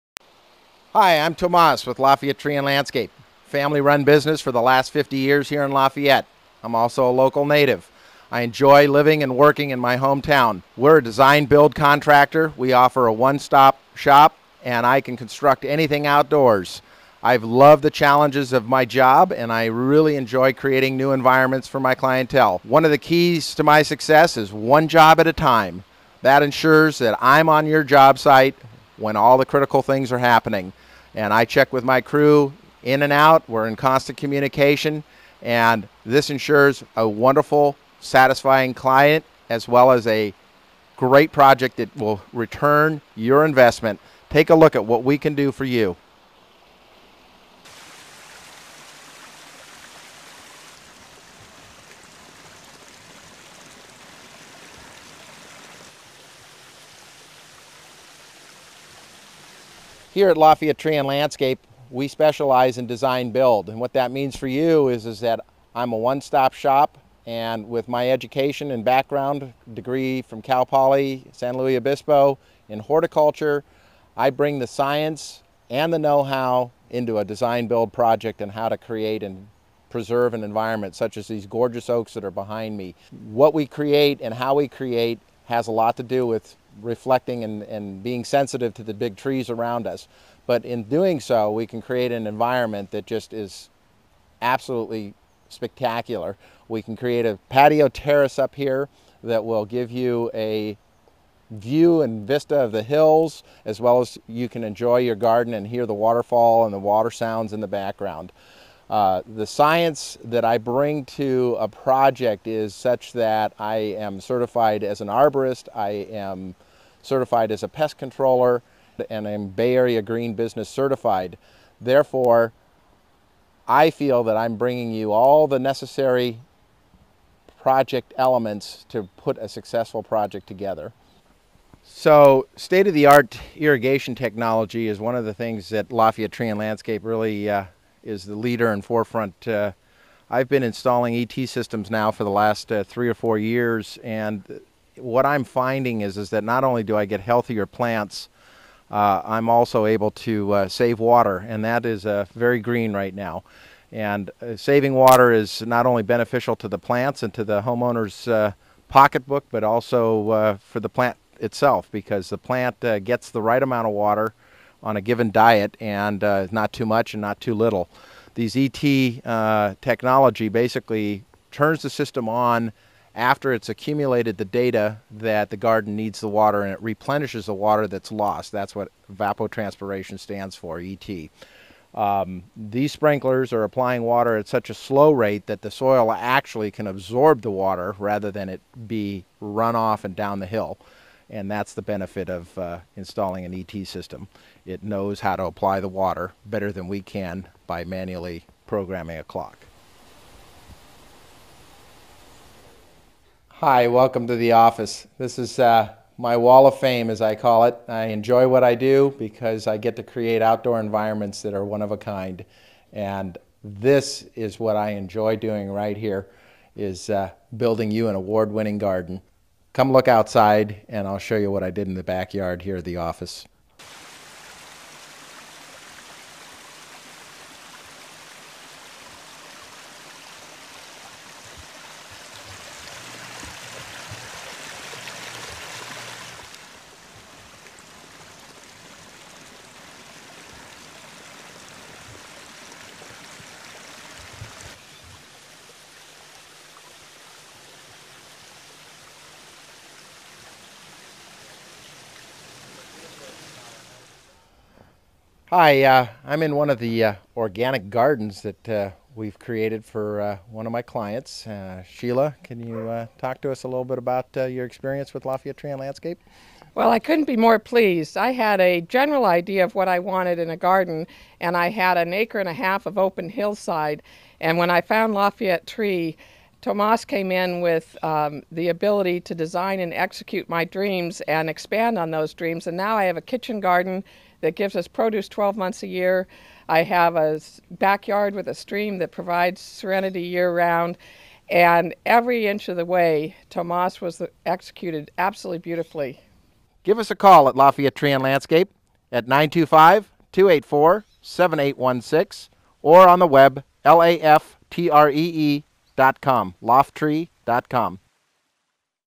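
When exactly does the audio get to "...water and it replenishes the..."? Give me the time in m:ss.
2:56.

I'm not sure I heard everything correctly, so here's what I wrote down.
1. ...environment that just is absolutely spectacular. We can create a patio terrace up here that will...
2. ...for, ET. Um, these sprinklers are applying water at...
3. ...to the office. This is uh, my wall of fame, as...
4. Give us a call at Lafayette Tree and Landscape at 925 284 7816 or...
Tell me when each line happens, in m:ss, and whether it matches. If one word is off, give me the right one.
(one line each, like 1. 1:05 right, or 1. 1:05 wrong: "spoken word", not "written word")
1. 1:32 right
2. 3:00 right
3. 3:24 right
4. 4:56 right.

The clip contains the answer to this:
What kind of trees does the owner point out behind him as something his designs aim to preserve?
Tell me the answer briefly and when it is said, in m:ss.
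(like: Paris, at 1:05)
Oaks, at 1:21.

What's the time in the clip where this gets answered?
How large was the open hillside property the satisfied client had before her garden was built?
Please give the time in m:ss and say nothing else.
4:31.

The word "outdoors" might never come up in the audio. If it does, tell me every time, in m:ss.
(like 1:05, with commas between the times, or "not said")
0:16, 3:30.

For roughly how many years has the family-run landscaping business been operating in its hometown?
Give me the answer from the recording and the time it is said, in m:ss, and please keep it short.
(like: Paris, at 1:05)
50 years, at 0:04.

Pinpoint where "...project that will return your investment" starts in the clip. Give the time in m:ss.
0:41.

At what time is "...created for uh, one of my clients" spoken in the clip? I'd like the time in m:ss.
4:19.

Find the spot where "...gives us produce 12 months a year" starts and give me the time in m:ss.
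4:44.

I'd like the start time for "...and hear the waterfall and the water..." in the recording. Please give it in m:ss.
1:45.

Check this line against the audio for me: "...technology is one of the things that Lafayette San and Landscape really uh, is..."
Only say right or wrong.
wrong.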